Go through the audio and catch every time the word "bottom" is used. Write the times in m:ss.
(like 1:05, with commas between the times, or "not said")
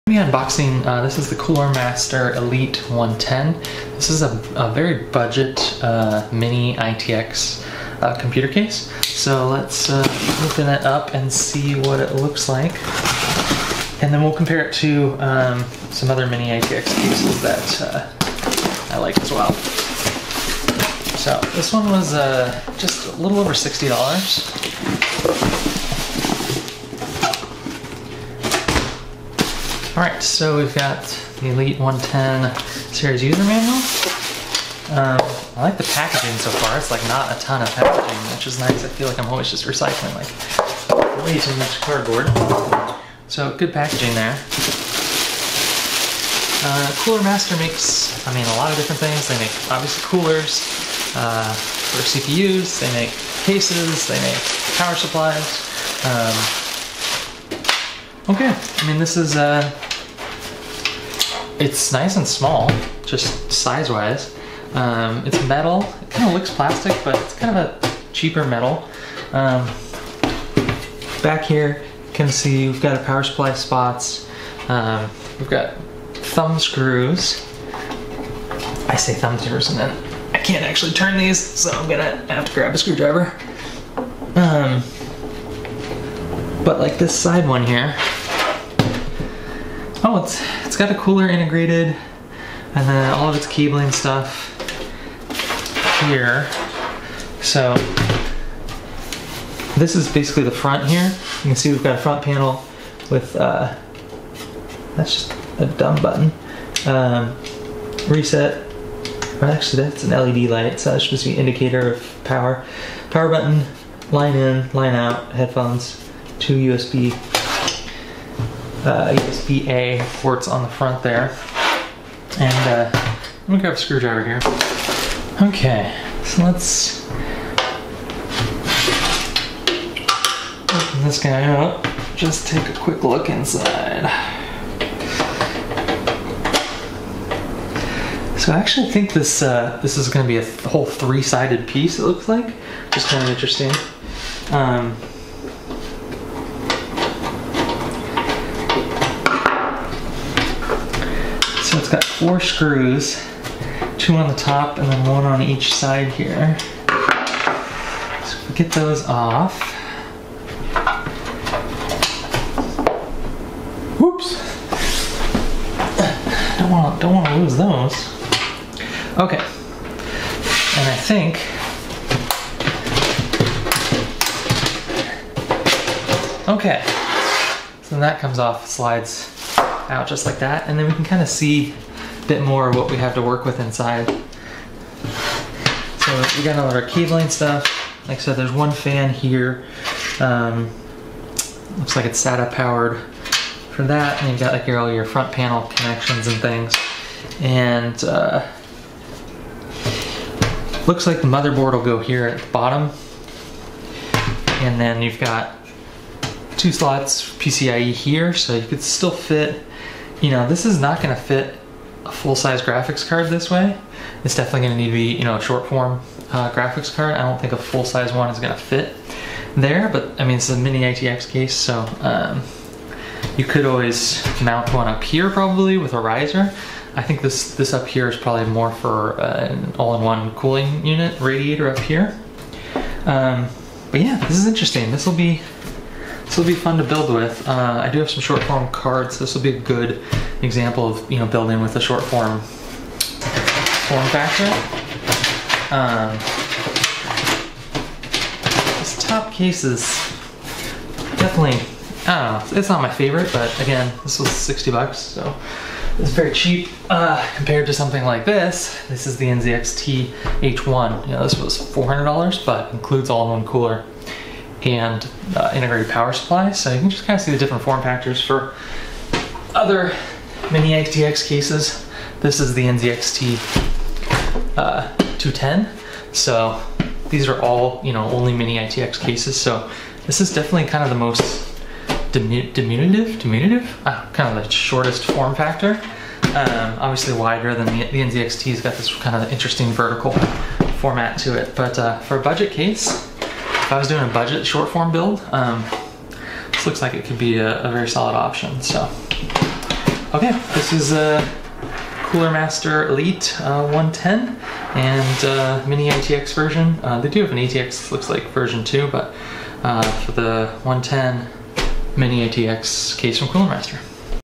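3:22.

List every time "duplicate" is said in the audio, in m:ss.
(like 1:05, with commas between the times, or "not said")
not said.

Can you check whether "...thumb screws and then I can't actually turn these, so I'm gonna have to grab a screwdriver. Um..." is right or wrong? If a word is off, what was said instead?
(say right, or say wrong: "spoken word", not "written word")
right.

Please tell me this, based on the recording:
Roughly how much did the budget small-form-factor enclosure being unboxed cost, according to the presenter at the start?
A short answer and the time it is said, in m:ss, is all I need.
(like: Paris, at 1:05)
a little over $60, at 0:22.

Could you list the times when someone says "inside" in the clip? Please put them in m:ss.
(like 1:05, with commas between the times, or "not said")
2:13, 3:03.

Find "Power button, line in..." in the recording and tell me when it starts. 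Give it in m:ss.
1:53.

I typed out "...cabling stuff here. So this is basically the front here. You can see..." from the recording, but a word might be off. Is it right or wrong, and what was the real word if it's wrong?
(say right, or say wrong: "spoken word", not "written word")
right.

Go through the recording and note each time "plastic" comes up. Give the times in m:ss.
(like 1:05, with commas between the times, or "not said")
1:06.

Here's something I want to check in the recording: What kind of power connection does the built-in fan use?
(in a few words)
SATA.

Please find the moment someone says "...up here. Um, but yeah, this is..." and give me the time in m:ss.
3:51.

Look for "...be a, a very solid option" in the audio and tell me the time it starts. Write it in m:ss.
4:57.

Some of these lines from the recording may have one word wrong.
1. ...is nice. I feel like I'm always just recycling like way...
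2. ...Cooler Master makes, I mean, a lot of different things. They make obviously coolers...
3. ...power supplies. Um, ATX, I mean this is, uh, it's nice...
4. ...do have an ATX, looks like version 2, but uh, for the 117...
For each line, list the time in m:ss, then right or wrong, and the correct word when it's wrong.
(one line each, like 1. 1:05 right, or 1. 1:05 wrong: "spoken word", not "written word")
1. 0:38 right
2. 0:47 right
3. 0:54 wrong: "Okay", not "ATX"
4. 5:07 wrong: "110", not "117".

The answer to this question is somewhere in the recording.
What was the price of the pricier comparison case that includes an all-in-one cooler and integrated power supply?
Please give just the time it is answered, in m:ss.
4:21.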